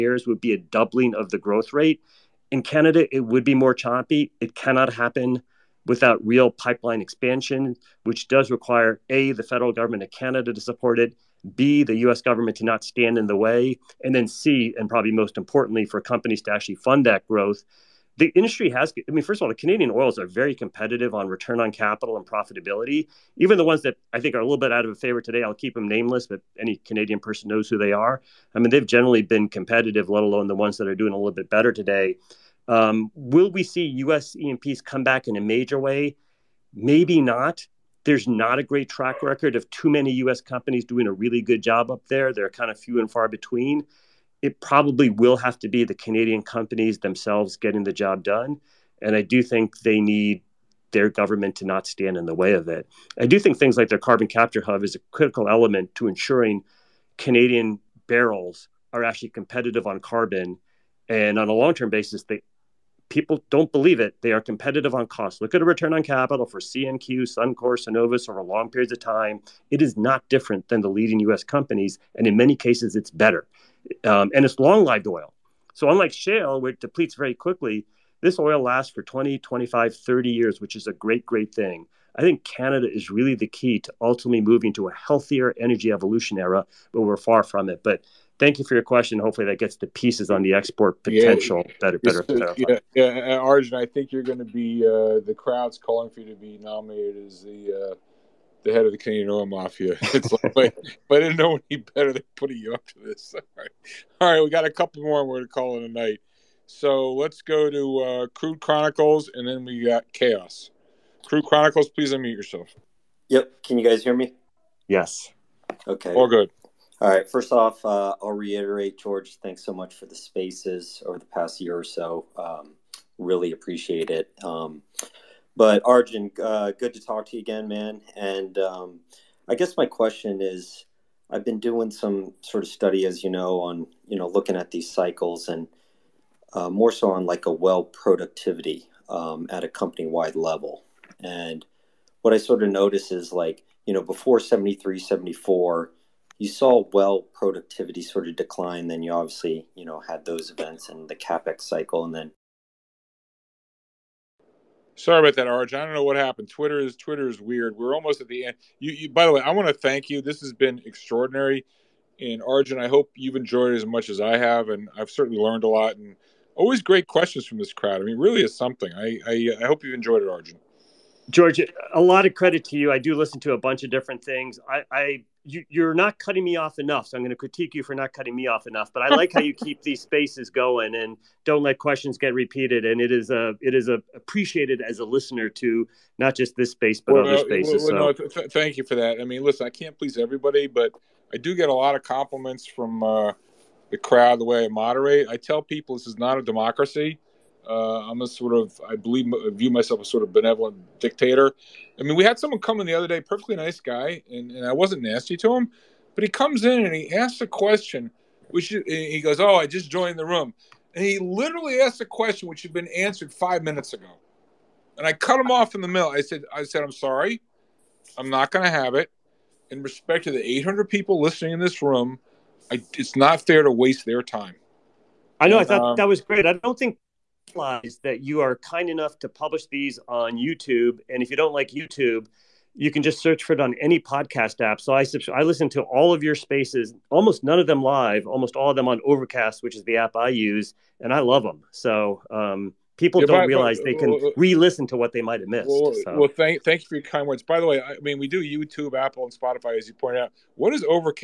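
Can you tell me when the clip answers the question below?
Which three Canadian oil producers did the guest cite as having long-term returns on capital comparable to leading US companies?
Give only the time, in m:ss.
1:06.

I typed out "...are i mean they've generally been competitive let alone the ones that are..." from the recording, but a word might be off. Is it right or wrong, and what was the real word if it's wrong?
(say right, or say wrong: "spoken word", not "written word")
right.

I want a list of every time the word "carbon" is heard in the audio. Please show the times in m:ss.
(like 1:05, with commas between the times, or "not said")
0:53, 1:00.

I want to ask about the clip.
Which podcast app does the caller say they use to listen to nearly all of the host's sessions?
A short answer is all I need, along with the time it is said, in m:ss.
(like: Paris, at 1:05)
Overcast, at 3:59.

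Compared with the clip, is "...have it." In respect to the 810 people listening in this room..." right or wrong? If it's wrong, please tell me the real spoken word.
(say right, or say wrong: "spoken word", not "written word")
wrong: "800", not "810".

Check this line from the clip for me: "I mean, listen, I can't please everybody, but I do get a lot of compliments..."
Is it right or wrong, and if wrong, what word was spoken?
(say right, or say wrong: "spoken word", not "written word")
right.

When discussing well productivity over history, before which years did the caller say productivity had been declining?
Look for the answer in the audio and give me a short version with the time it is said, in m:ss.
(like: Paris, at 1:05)
73, 74, at 2:24.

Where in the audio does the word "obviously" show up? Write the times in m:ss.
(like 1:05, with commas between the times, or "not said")
2:29.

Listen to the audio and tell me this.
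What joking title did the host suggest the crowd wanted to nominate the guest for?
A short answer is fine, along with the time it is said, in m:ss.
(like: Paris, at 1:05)
head of the Canadian oil mafia, at 1:38.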